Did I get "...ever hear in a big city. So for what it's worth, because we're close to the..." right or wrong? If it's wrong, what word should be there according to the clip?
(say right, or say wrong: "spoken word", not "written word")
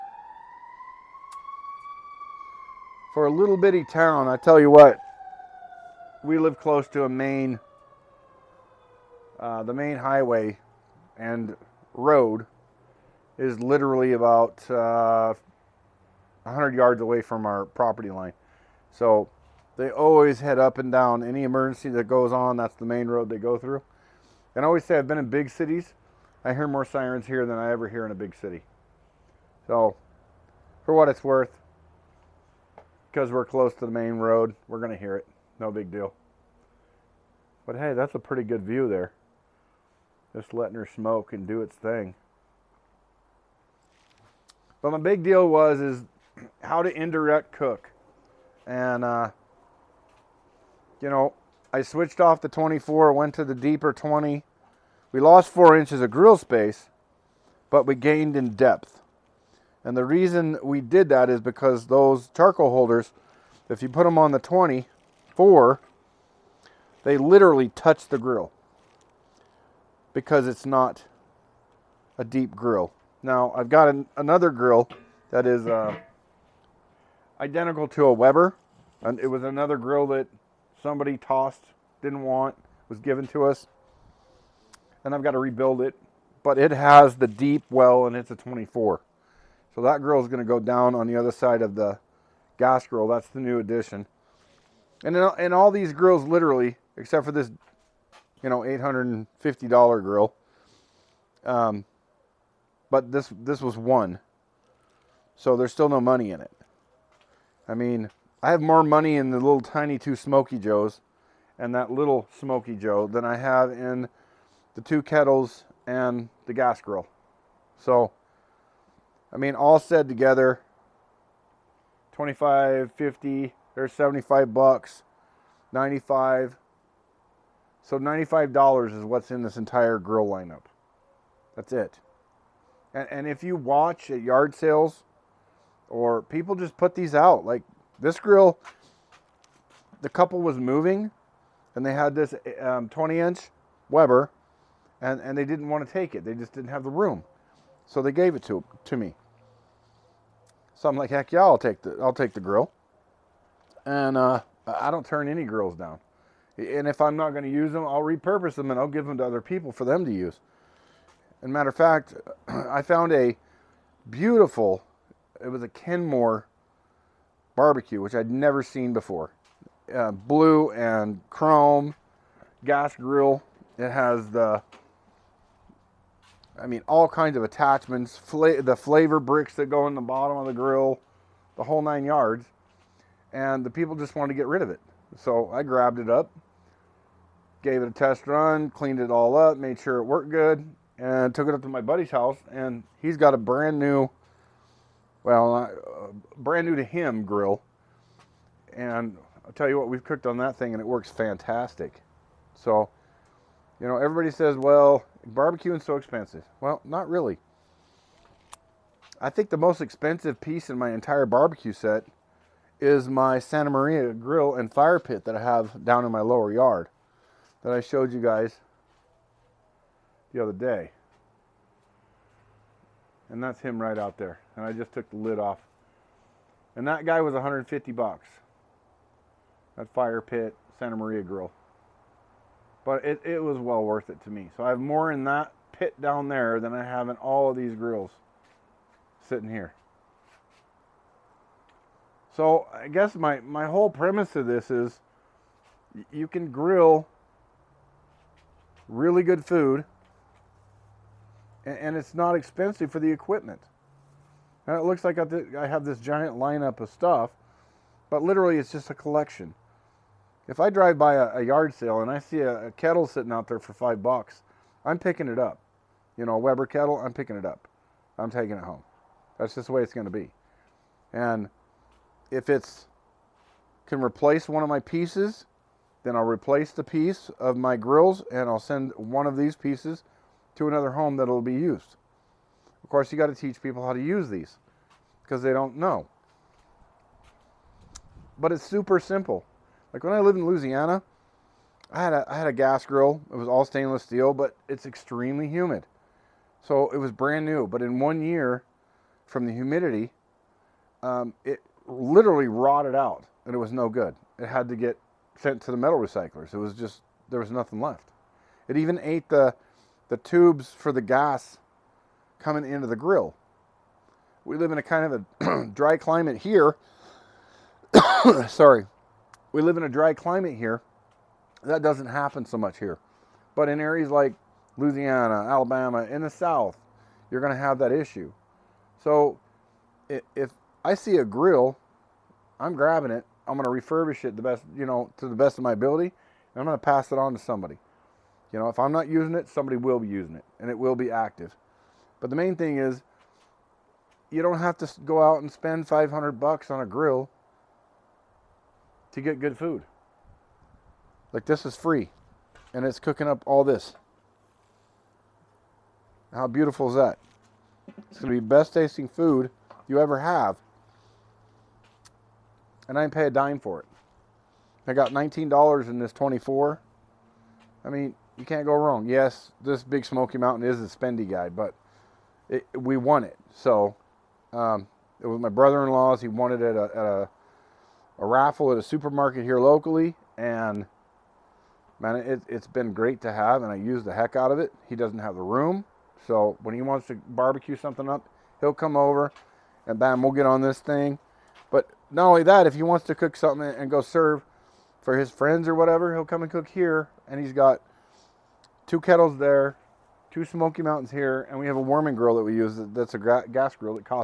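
right.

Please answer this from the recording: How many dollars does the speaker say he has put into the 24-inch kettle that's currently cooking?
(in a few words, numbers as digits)
$19.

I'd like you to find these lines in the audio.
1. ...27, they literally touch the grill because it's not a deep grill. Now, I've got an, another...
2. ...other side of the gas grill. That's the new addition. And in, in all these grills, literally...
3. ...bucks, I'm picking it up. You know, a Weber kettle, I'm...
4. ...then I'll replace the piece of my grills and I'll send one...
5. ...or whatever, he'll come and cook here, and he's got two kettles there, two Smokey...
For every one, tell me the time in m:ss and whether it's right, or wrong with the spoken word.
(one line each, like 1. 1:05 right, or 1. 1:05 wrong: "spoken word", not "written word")
1. 1:04 wrong: "24", not "27"
2. 1:31 right
3. 4:24 right
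4. 4:36 right
5. 6:35 right.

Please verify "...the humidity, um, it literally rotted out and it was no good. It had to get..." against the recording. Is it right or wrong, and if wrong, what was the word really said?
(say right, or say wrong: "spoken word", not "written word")
right.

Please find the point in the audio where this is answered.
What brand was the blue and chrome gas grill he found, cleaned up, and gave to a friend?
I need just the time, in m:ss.
2:45.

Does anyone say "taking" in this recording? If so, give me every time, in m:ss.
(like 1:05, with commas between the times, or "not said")
4:28.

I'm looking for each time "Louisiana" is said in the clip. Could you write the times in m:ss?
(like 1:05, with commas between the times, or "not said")
4:50, 5:24.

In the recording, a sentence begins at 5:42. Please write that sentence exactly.
But the main thing is, you don't have to go out and spend 500 bucks on a grill to get good food.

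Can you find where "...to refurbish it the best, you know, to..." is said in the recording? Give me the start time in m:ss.
5:33.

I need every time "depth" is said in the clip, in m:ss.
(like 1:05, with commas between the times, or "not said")
0:58.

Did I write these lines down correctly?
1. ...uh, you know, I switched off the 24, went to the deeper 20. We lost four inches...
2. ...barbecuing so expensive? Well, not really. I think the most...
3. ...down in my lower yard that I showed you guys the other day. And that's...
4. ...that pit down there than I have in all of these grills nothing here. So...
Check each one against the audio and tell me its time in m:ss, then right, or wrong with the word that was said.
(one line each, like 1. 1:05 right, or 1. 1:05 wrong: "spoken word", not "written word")
1. 0:49 right
2. 3:25 right
3. 3:35 right
4. 3:55 wrong: "sitting", not "nothing".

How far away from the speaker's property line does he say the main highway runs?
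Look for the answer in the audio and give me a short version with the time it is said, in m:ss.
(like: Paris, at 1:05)
100 yards, at 0:16.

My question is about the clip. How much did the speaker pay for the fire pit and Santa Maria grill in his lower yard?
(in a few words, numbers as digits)
$150.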